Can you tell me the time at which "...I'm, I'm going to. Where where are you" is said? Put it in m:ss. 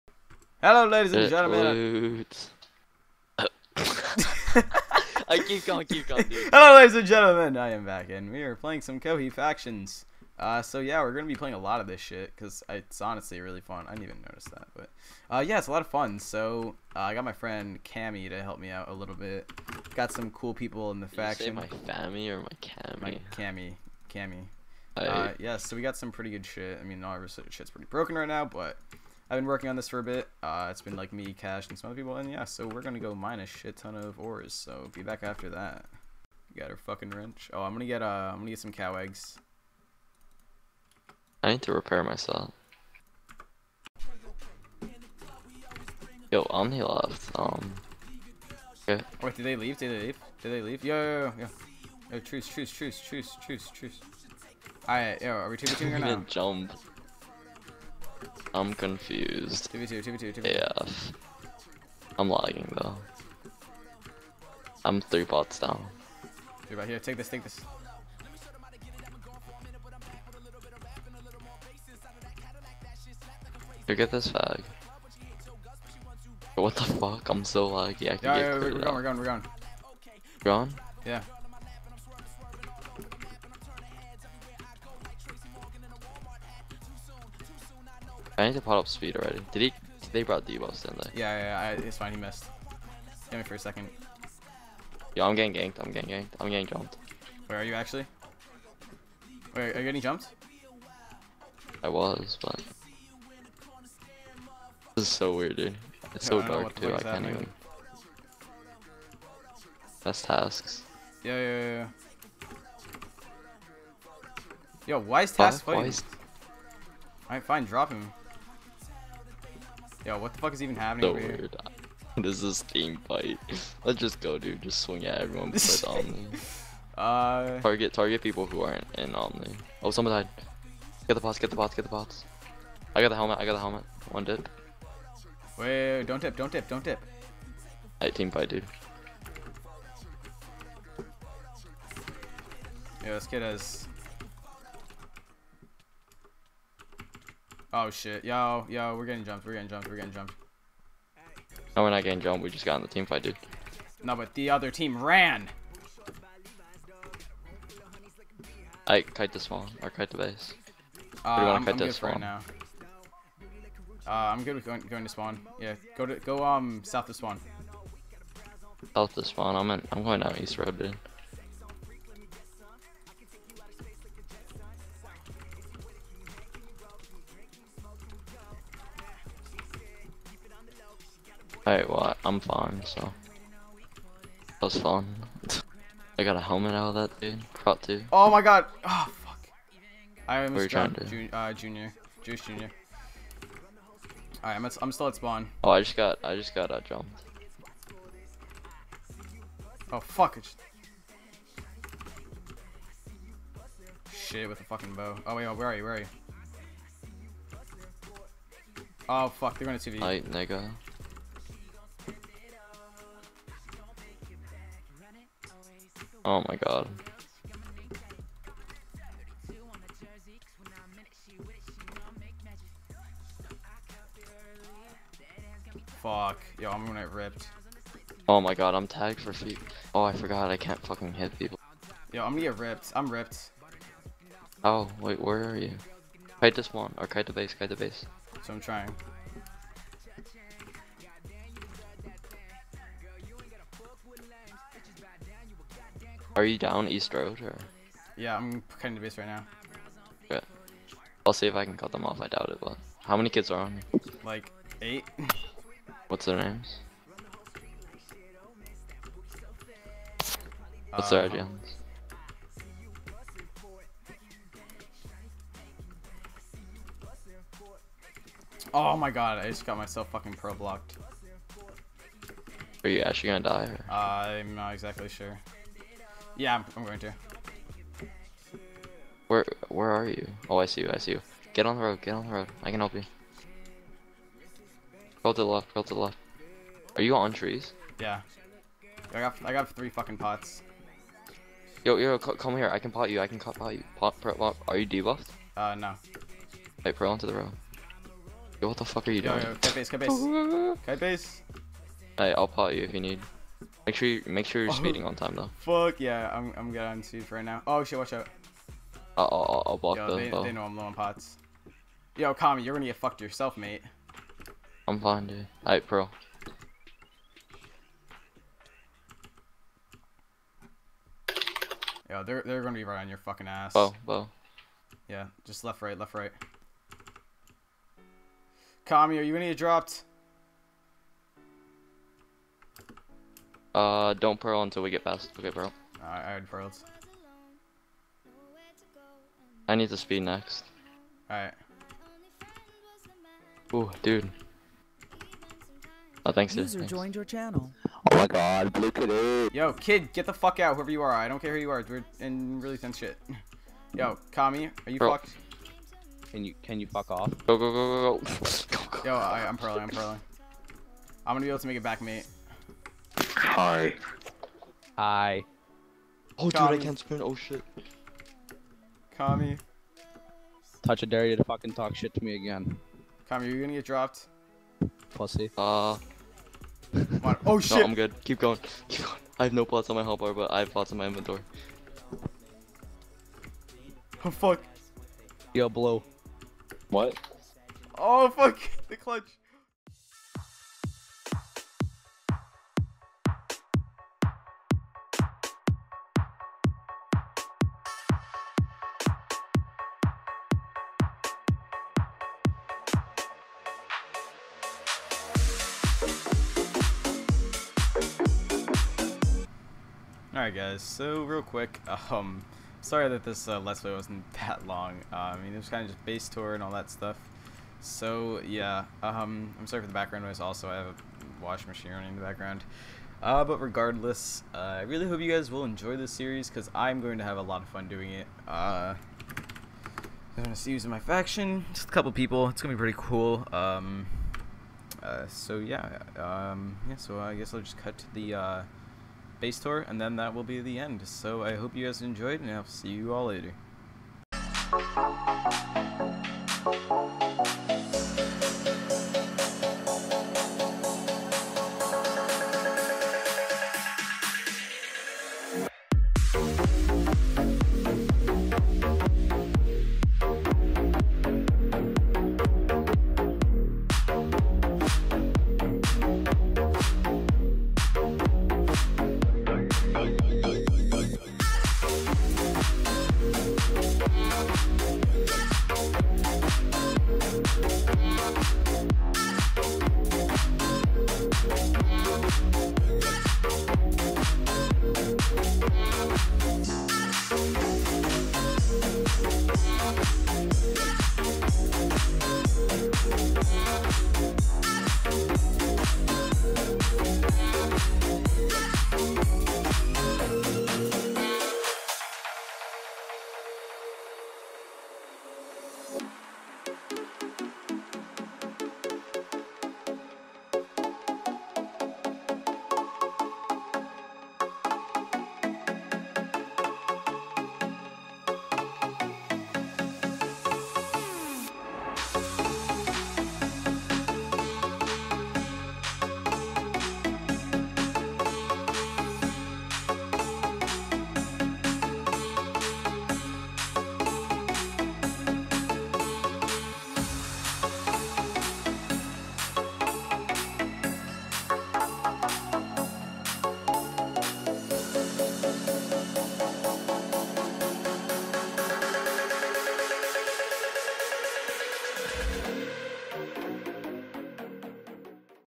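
4:36.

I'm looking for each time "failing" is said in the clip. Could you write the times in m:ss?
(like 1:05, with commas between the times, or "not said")
not said.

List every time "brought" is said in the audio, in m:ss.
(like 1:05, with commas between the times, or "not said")
1:30.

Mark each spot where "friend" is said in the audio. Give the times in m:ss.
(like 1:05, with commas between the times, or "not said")
0:17.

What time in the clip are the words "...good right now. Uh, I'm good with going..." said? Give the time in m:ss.
2:41.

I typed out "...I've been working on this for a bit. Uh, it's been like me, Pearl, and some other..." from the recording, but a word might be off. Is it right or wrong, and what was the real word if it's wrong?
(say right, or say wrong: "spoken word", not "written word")
wrong: "Cash", not "Pearl".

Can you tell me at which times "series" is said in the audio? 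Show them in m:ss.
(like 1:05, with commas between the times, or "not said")
7:06.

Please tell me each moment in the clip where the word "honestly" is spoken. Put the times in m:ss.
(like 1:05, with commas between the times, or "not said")
0:13.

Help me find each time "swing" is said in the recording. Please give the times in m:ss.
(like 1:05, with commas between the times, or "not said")
2:04.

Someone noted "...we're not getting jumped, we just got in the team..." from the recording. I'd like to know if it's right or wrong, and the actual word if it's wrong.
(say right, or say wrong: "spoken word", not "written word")
right.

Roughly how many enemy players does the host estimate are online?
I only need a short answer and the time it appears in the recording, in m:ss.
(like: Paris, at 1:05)
8, at 4:14.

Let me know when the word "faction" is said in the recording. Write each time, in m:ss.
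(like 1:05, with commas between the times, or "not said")
0:09, 0:21, 7:10.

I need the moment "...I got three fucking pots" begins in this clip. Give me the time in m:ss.
4:49.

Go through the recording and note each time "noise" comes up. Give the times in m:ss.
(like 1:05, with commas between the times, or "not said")
7:00.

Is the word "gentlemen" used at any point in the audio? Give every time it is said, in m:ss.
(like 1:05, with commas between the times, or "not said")
0:01, 0:07.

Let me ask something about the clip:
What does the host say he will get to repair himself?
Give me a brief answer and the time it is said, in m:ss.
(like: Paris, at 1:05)
cow eggs, at 0:38.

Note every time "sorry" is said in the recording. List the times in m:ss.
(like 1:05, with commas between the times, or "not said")
6:52, 6:59.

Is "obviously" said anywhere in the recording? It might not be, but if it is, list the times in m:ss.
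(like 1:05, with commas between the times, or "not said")
0:27.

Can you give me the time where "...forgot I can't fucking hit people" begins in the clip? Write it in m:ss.
3:50.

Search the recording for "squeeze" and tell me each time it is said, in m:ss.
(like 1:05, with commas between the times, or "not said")
not said.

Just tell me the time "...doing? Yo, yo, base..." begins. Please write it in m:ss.
4:59.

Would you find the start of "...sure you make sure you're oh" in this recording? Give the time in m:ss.
5:03.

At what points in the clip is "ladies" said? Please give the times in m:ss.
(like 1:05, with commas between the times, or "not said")
0:00, 0:06.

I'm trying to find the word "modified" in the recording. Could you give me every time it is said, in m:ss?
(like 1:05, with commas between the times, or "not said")
not said.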